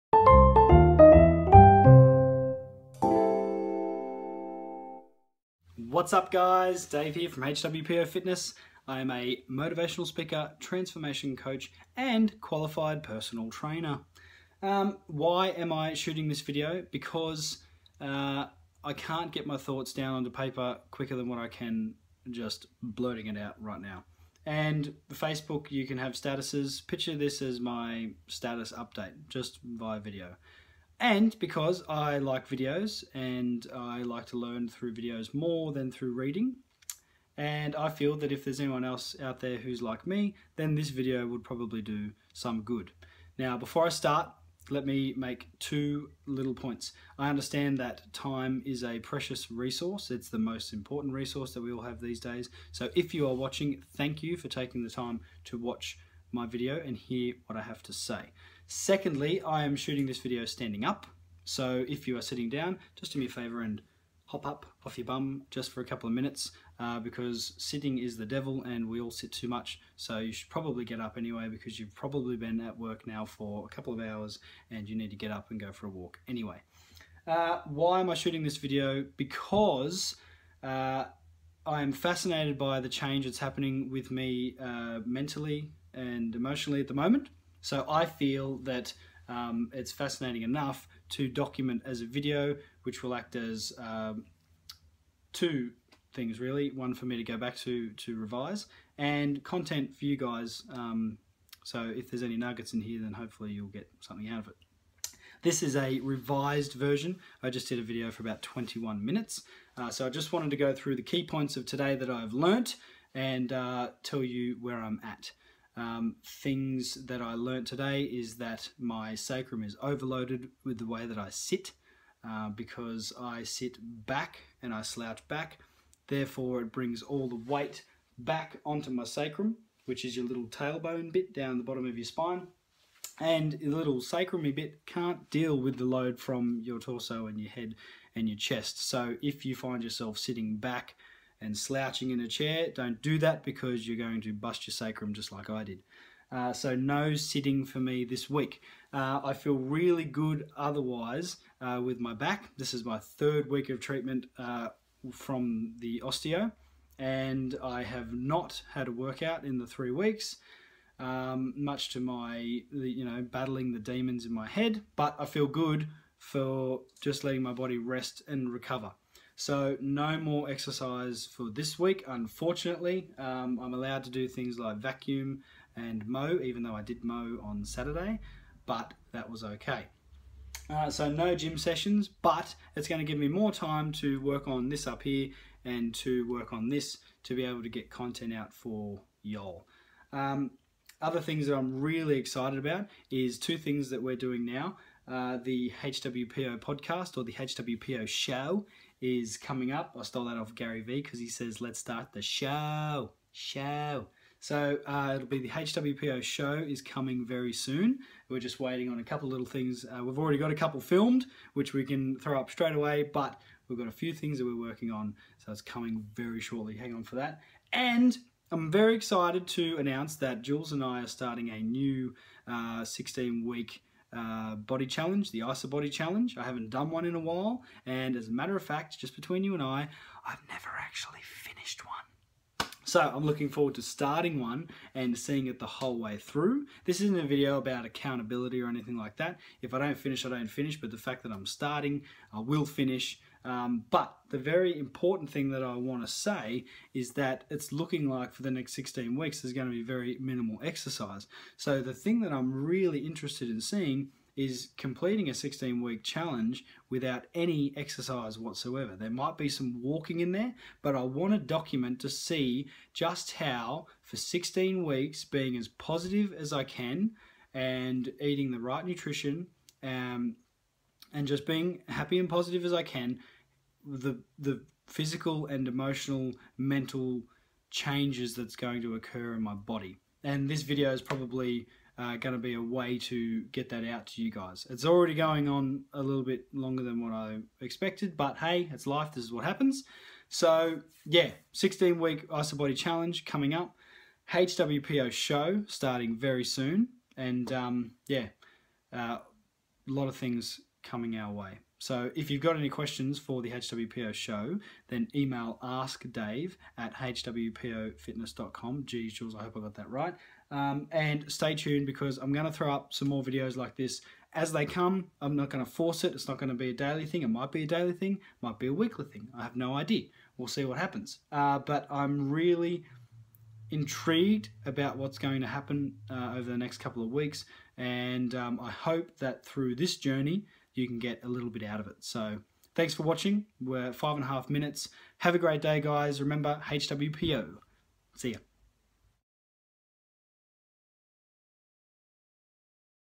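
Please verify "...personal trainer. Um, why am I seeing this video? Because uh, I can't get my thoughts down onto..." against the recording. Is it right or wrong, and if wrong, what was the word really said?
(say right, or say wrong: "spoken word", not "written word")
wrong: "shooting", not "seeing".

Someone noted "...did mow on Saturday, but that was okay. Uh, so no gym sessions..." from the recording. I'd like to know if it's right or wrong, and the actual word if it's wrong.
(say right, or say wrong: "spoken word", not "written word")
right.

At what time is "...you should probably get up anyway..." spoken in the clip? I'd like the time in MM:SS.
01:10.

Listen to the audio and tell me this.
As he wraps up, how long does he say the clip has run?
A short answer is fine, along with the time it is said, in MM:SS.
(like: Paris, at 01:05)
five and a half minutes, at 05:33.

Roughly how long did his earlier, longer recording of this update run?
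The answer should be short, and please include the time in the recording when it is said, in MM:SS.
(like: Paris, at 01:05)
21 minutes, at 01:48.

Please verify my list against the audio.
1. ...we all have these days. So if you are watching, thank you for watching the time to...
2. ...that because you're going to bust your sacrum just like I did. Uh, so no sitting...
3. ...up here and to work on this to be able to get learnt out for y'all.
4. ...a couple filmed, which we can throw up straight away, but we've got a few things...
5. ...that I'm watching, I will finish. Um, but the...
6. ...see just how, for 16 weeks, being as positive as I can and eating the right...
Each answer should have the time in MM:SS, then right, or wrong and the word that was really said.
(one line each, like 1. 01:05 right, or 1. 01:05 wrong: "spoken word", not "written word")
1. 00:51 wrong: "taking", not "watching"
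2. 02:23 right
3. 03:04 wrong: "content", not "learnt"
4. 03:30 right
5. 04:01 wrong: "starting", not "watching"
6. 04:22 right.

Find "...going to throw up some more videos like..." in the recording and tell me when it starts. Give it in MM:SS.
05:12.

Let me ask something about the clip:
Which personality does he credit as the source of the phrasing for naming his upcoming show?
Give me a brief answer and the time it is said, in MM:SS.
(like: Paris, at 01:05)
Gary Vee, at 03:20.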